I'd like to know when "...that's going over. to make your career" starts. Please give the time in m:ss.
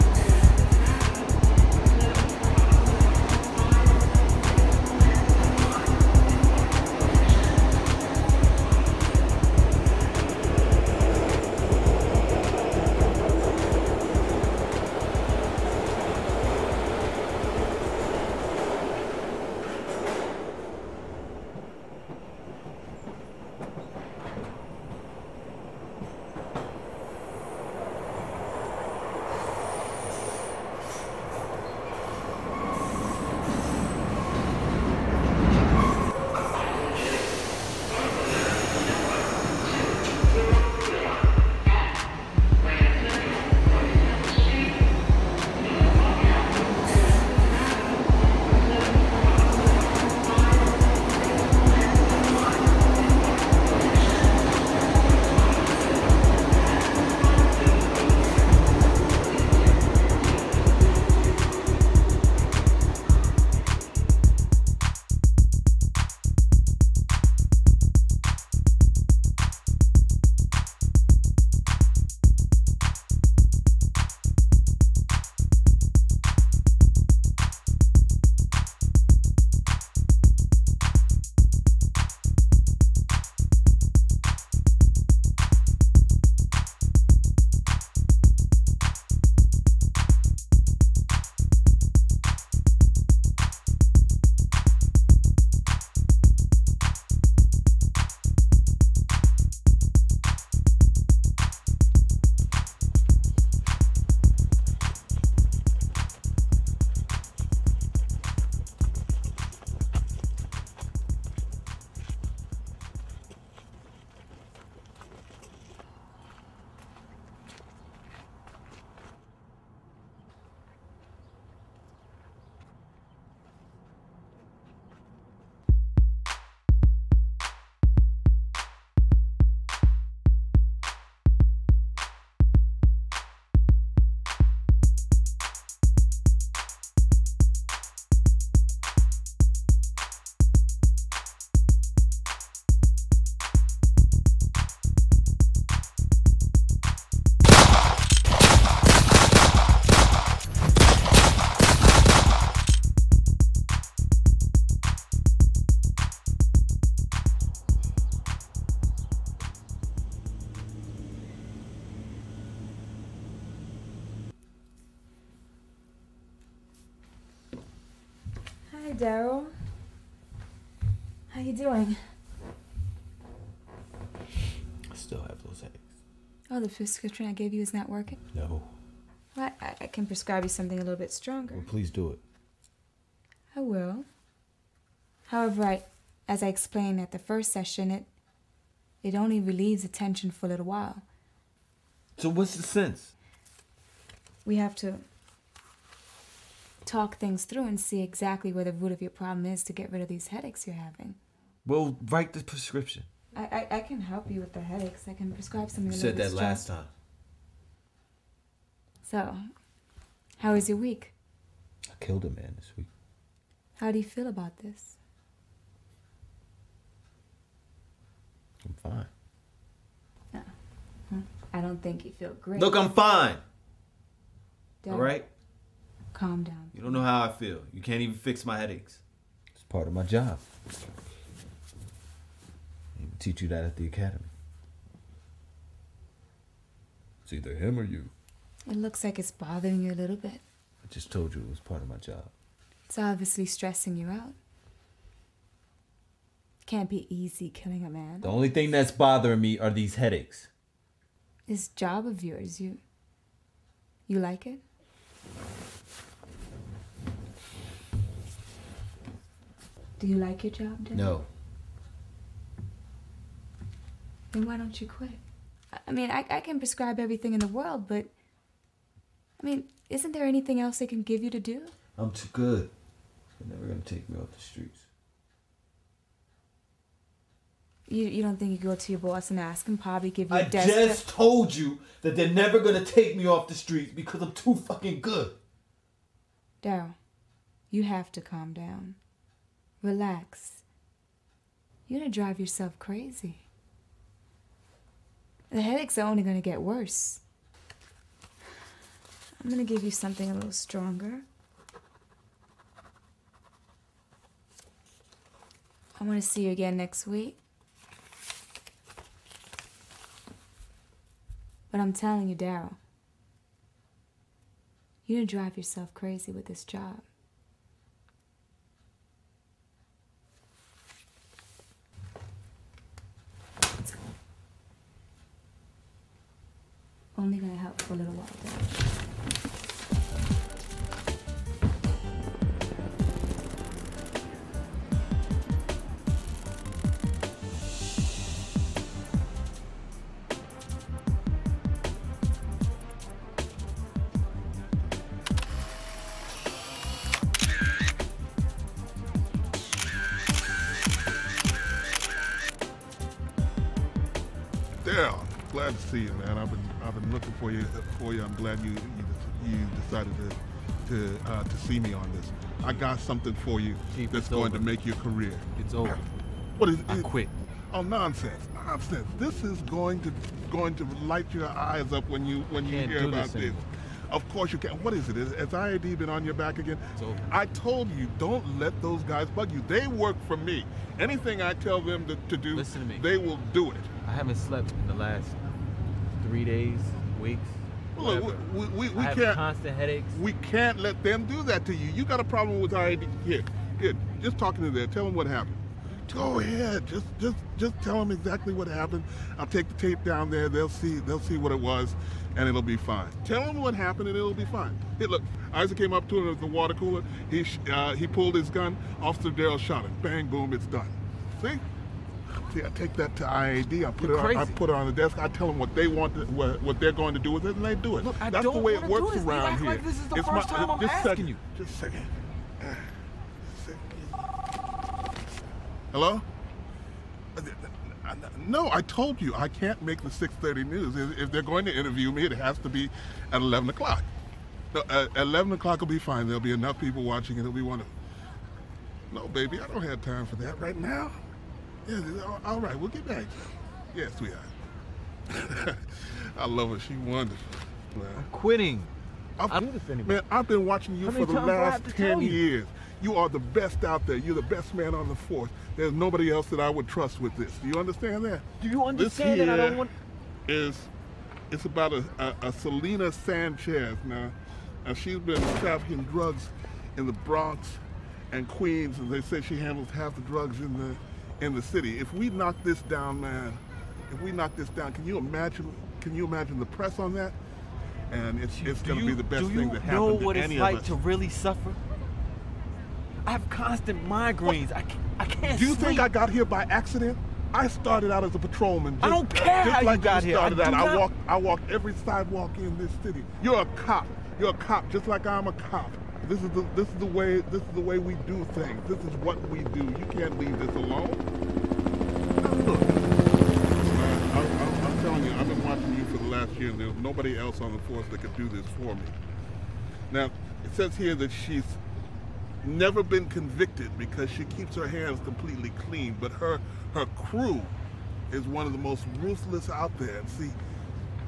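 6:04.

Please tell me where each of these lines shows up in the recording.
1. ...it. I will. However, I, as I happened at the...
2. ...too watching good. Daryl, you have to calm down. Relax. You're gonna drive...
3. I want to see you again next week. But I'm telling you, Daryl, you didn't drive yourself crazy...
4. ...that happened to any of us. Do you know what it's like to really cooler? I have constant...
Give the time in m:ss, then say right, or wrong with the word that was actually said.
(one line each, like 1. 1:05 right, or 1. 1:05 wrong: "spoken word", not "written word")
1. 3:02 wrong: "explained", not "happened"
2. 4:44 wrong: "fucking", not "watching"
3. 5:06 right
4. 7:59 wrong: "suffer", not "cooler".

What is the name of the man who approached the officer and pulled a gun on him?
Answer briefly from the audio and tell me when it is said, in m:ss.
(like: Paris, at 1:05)
Isaac, at 6:45.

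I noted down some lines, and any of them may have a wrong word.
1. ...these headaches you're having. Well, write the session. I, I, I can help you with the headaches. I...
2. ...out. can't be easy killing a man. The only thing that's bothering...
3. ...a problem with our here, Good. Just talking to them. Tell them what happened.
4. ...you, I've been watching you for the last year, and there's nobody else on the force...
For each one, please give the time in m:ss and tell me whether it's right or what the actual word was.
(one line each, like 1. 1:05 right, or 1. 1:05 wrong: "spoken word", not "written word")
1. 3:20 wrong: "prescription", not "session"
2. 4:04 right
3. 6:32 right
4. 8:25 right.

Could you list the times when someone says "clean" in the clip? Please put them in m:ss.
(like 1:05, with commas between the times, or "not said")
8:35.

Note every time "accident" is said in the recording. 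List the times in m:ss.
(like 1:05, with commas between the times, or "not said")
8:06.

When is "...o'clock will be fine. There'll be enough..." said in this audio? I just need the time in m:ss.
7:15.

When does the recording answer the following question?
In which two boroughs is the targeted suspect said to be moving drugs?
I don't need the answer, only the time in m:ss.
7:47.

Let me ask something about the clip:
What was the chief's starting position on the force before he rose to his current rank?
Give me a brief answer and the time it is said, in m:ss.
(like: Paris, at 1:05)
patrolman, at 8:08.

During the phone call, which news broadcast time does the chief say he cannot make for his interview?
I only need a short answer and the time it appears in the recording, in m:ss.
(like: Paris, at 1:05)
6:30, at 7:10.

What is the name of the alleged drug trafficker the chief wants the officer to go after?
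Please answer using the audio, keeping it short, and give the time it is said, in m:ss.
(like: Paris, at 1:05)
Selena Sanchez, at 7:42.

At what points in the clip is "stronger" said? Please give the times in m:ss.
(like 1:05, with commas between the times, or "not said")
3:01, 5:00.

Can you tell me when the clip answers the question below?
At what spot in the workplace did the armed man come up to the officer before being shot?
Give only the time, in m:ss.
6:46.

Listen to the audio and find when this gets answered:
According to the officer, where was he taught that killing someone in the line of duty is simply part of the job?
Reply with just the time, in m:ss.
3:53.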